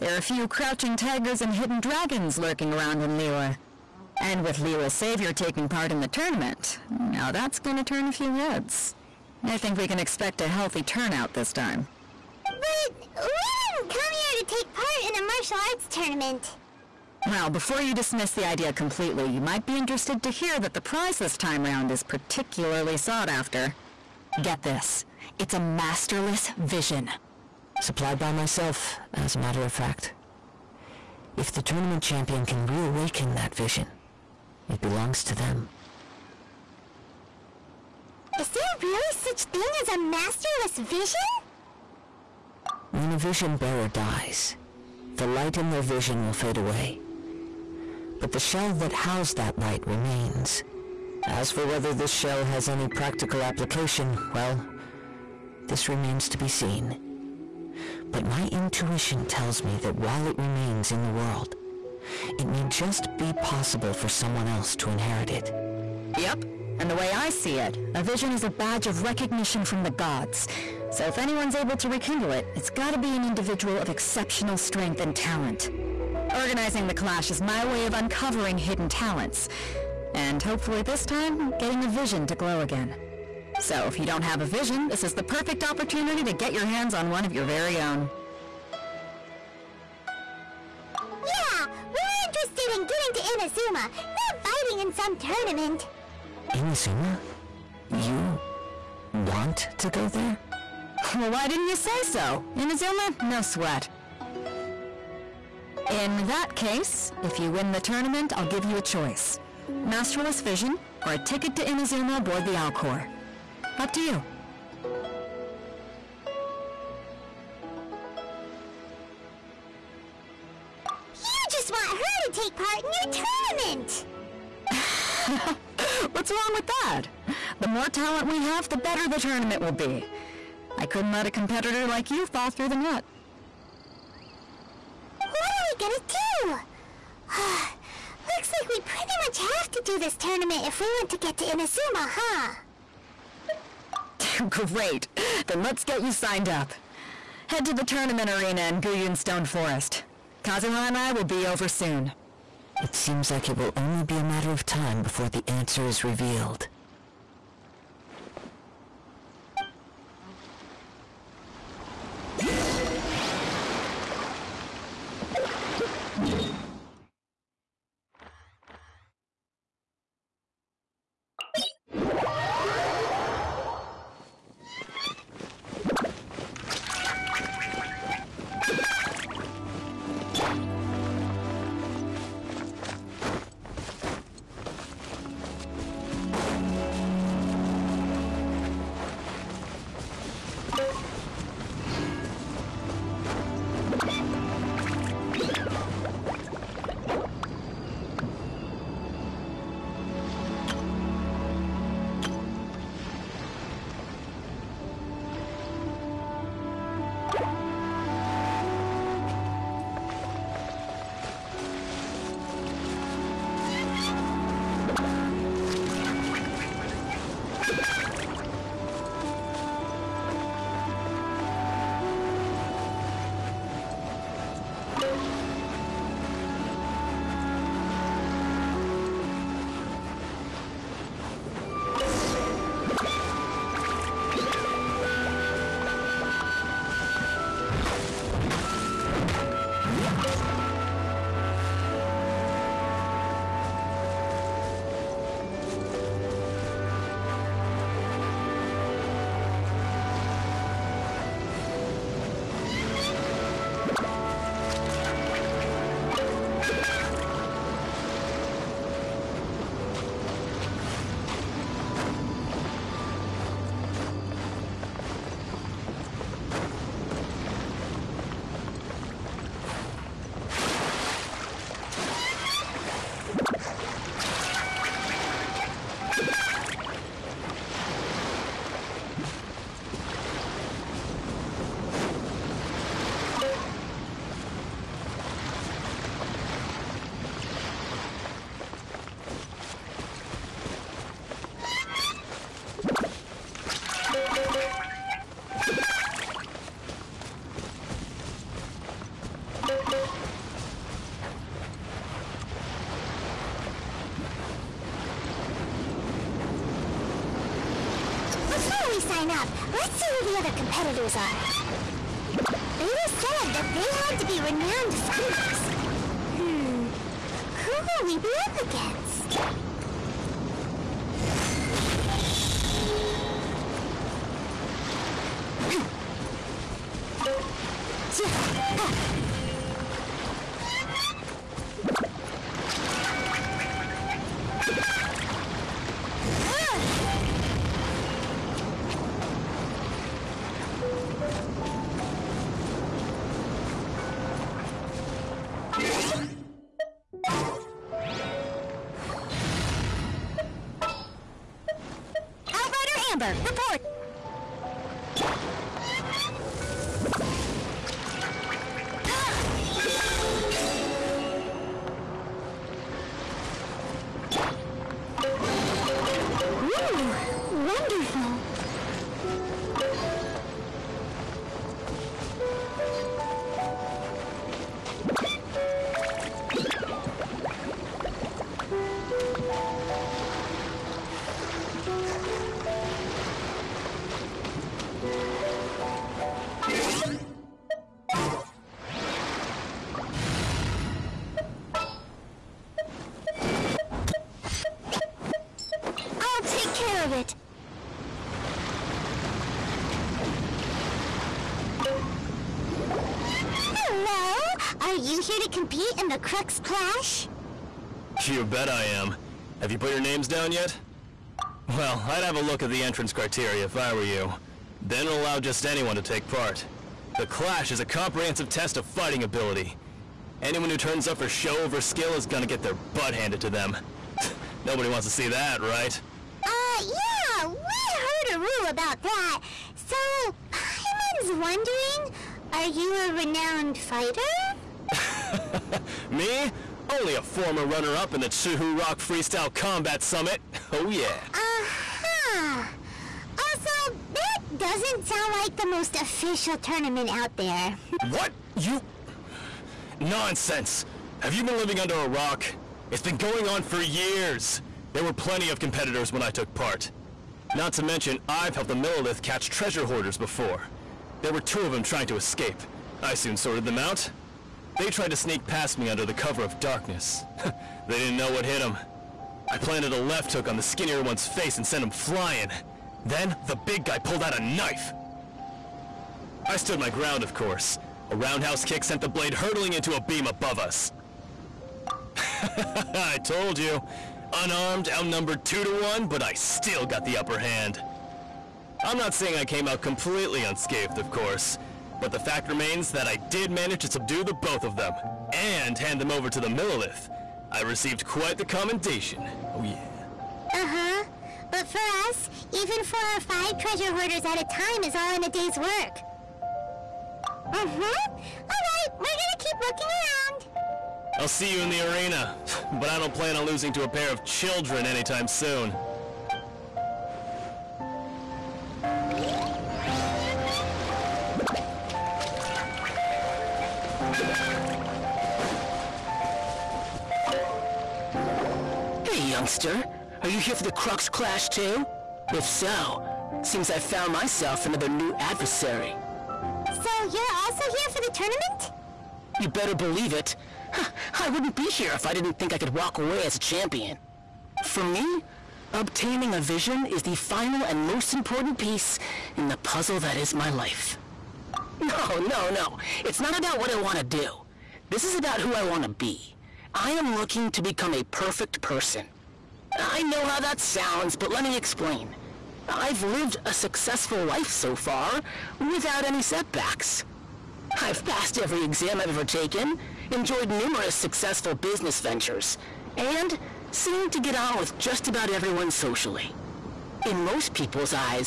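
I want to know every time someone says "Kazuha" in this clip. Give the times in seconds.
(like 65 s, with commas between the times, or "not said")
150 s.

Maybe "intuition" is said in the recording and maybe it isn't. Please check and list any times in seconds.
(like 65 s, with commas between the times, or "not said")
58 s.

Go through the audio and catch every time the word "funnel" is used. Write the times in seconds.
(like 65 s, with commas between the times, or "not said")
not said.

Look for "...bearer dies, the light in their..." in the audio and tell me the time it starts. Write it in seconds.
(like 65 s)
43 s.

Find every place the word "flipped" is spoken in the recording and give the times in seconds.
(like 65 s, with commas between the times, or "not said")
not said.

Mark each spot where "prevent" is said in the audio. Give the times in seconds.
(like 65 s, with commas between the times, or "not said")
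not said.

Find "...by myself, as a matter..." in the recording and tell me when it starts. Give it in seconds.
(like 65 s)
28 s.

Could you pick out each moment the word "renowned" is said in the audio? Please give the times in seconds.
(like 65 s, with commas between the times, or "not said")
314 s, 433 s.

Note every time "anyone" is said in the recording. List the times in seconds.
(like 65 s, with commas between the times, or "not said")
71 s, 415 s, 420 s.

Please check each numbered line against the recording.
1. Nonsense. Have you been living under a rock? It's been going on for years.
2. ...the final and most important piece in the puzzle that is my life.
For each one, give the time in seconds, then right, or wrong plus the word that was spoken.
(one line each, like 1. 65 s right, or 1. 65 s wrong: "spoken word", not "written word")
1. 449 s right
2. 547 s right.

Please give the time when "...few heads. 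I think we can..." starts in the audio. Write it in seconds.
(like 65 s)
8 s.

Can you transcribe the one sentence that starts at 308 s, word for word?
we sign up, let's see who the other competitors are.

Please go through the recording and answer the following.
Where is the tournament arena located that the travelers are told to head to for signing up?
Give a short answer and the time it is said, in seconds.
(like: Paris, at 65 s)
Guyun Stone Forest, at 148 s.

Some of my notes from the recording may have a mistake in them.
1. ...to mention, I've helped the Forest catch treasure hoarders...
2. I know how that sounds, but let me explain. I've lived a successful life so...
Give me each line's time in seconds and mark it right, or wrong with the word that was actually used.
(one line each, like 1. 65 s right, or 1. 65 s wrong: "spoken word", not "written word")
1. 457 s wrong: "Millelith", not "Forest"
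2. 559 s right.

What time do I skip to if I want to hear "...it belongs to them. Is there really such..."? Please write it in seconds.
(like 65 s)
34 s.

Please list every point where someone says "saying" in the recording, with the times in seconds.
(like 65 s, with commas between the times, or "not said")
489 s.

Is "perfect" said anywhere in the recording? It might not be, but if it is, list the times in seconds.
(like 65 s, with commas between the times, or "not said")
85 s, 558 s.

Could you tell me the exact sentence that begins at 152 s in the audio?
It seems like it will only be a matter of time before the answer is revealed.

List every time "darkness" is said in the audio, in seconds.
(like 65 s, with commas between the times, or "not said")
466 s.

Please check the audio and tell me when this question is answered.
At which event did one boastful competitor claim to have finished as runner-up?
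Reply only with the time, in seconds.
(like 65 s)
438 s.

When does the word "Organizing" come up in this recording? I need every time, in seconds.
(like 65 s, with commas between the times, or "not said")
76 s.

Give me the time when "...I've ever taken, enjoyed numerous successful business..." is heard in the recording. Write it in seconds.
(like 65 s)
568 s.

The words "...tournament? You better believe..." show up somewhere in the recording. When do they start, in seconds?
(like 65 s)
538 s.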